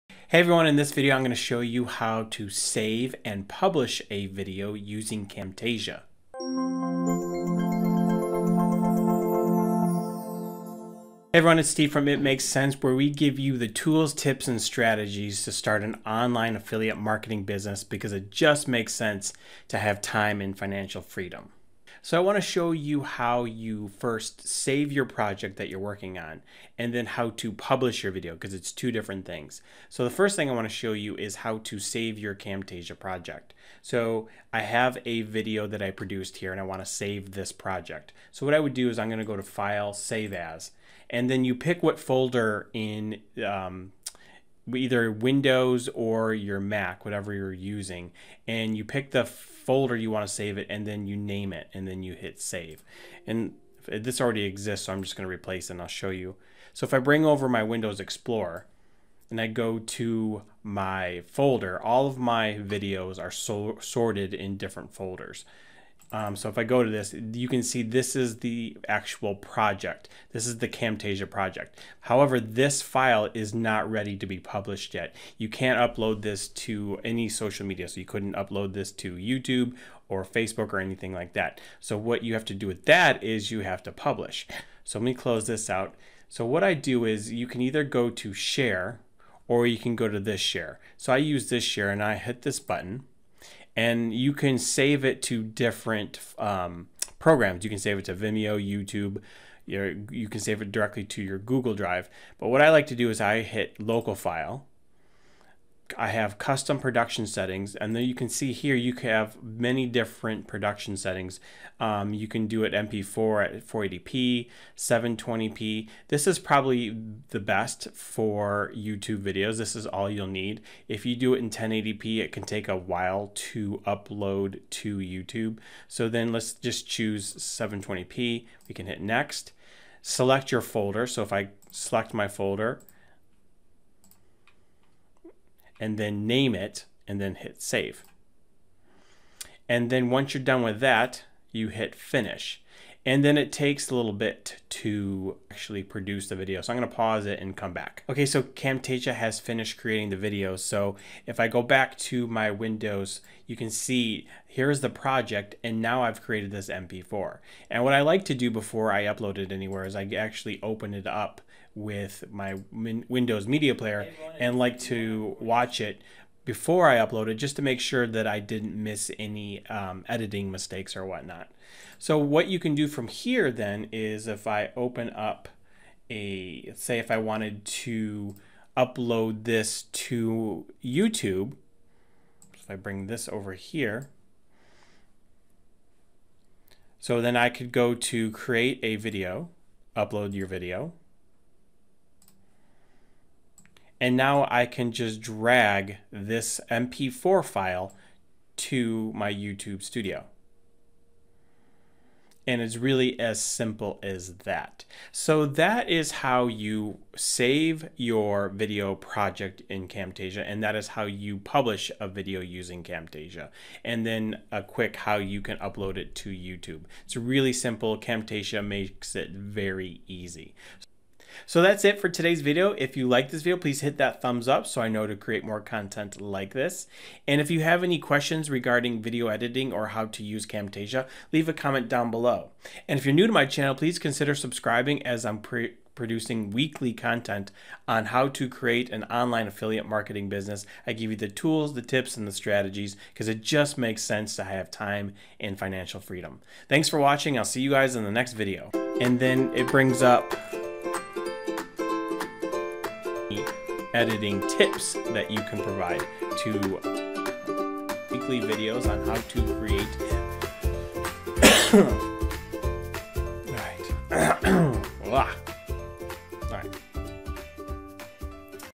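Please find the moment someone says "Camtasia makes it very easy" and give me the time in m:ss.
3:37.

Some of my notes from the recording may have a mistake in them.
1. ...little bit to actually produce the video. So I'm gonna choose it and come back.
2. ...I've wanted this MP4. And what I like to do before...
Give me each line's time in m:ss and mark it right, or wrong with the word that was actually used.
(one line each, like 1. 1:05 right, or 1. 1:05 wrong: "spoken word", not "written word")
1. 2:23 wrong: "pause", not "choose"
2. 2:36 wrong: "created", not "wanted".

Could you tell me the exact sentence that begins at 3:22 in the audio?
And it's really as simple as that.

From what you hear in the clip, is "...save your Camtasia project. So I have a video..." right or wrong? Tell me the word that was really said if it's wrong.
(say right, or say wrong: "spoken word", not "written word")
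right.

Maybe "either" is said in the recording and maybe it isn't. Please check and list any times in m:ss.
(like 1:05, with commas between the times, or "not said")
0:44, 1:27.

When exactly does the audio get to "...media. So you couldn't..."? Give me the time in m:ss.
1:17.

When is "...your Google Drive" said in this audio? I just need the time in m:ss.
1:41.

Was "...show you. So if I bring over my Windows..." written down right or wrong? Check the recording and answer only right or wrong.
right.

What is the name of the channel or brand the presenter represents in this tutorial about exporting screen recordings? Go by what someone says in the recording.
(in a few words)
It Makes Sense.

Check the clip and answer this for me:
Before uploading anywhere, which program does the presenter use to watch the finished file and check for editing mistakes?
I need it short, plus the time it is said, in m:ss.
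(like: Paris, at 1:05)
Windows Media Player, at 2:42.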